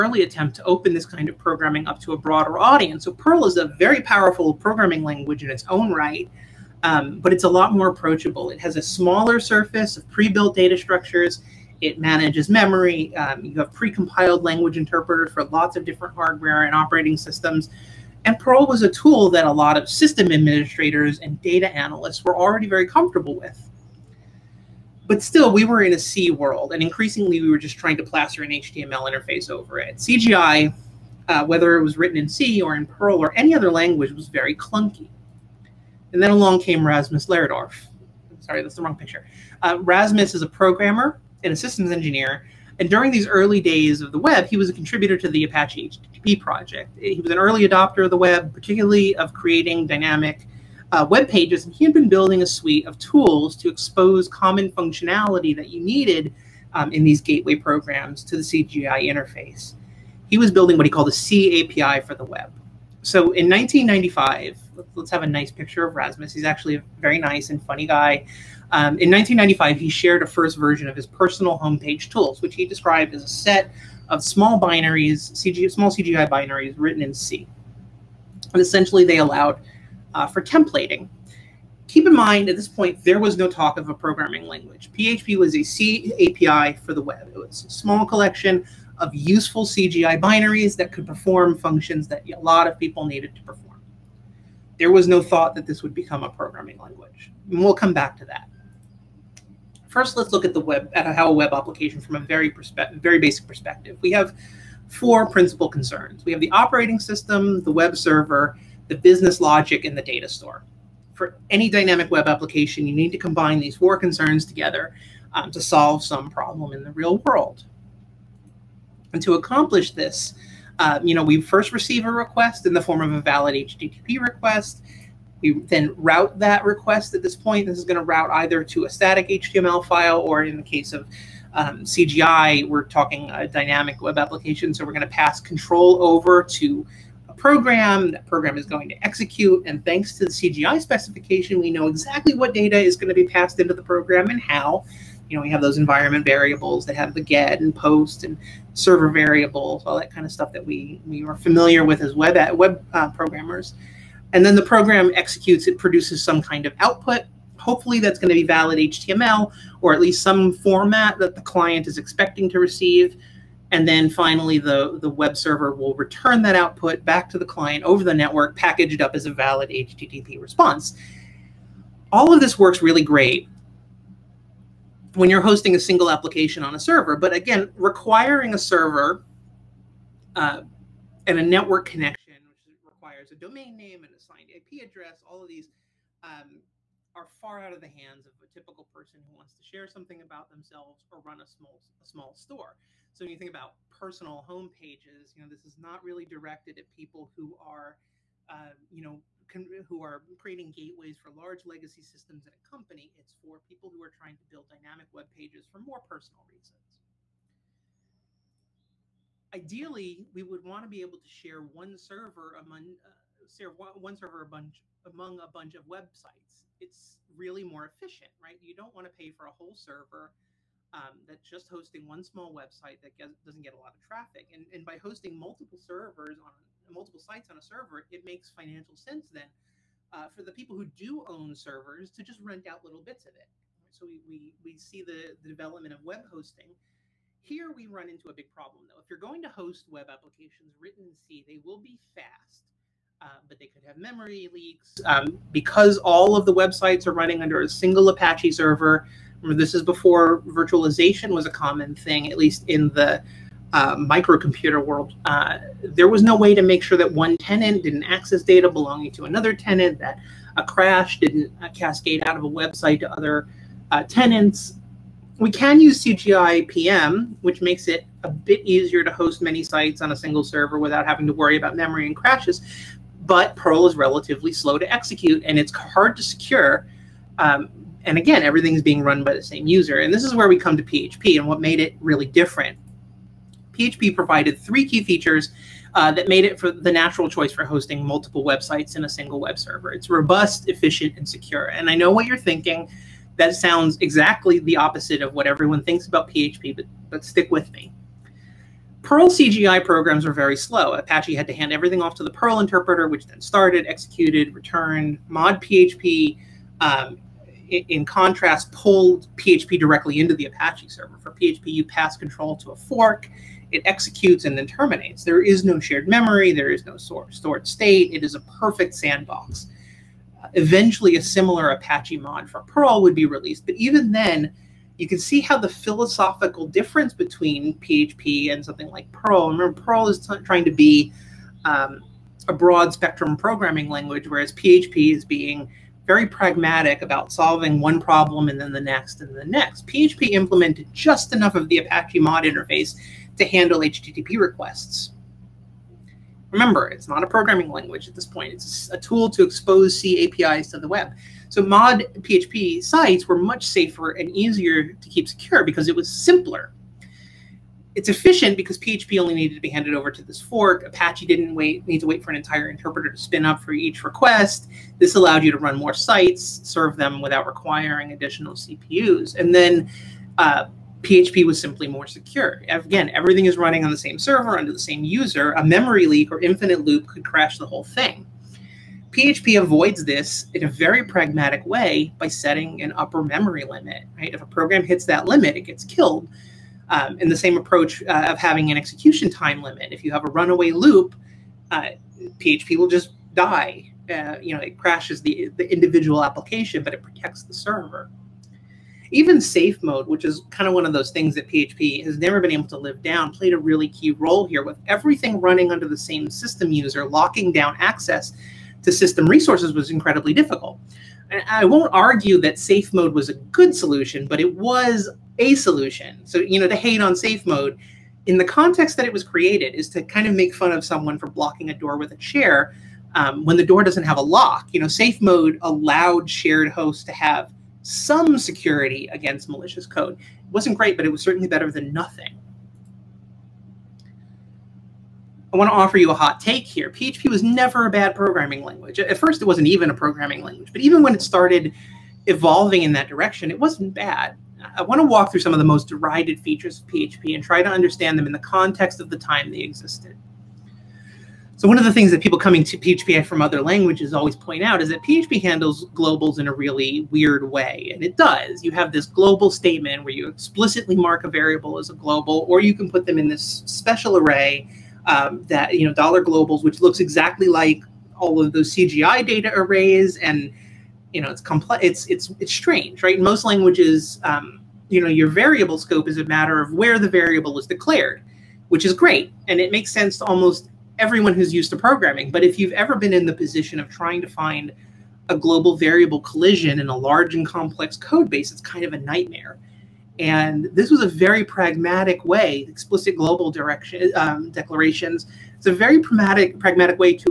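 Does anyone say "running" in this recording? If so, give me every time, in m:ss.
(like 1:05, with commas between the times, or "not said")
4:07, 6:13, 6:45.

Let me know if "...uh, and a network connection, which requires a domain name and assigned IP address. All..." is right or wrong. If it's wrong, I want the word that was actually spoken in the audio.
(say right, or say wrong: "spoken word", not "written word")
right.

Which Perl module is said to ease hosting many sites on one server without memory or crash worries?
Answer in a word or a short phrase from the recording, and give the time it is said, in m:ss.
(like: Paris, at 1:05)
CGI PM, at 4:26.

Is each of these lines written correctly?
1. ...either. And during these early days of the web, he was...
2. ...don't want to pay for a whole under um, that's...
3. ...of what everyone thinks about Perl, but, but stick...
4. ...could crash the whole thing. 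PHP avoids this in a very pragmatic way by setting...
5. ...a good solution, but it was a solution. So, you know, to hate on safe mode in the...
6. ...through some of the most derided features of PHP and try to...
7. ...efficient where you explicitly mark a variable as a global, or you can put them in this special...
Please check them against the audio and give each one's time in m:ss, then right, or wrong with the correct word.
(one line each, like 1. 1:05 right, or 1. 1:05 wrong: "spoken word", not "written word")
1. 0:41 wrong: "engineer", not "either"
2. 3:38 wrong: "server", not "under"
3. 4:55 wrong: "PHP", not "Perl"
4. 6:17 right
5. 6:53 right
6. 7:25 right
7. 7:39 wrong: "statement", not "efficient".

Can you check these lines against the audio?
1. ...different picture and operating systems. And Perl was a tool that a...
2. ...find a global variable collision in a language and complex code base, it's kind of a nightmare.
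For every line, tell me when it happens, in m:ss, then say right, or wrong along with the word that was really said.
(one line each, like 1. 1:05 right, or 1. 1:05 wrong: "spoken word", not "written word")
1. 0:15 wrong: "hardware", not "picture"
2. 8:04 wrong: "large", not "language".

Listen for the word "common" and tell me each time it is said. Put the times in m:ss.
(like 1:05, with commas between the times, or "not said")
0:54, 4:11.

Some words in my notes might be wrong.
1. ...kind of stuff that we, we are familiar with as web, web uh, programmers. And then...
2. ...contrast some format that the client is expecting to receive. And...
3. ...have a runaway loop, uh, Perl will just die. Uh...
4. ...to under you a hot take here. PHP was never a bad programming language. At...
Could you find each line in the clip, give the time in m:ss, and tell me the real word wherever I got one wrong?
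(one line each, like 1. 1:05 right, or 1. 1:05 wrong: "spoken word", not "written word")
1. 2:30 right
2. 2:40 wrong: "least", not "contrast"
3. 6:30 wrong: "PHP", not "Perl"
4. 7:15 wrong: "offer", not "under".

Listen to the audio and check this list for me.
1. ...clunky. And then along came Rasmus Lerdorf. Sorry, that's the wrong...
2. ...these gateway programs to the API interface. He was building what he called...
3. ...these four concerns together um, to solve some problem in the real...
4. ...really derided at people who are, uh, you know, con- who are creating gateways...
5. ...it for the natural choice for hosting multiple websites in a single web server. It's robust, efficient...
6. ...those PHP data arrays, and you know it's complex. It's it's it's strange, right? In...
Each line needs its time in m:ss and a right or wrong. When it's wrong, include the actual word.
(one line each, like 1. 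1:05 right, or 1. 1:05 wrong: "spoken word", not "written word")
1. 0:34 right
2. 0:57 wrong: "CGI", not "API"
3. 1:53 right
4. 3:16 wrong: "directed", not "derided"
5. 4:46 right
6. 7:48 wrong: "CGI", not "PHP".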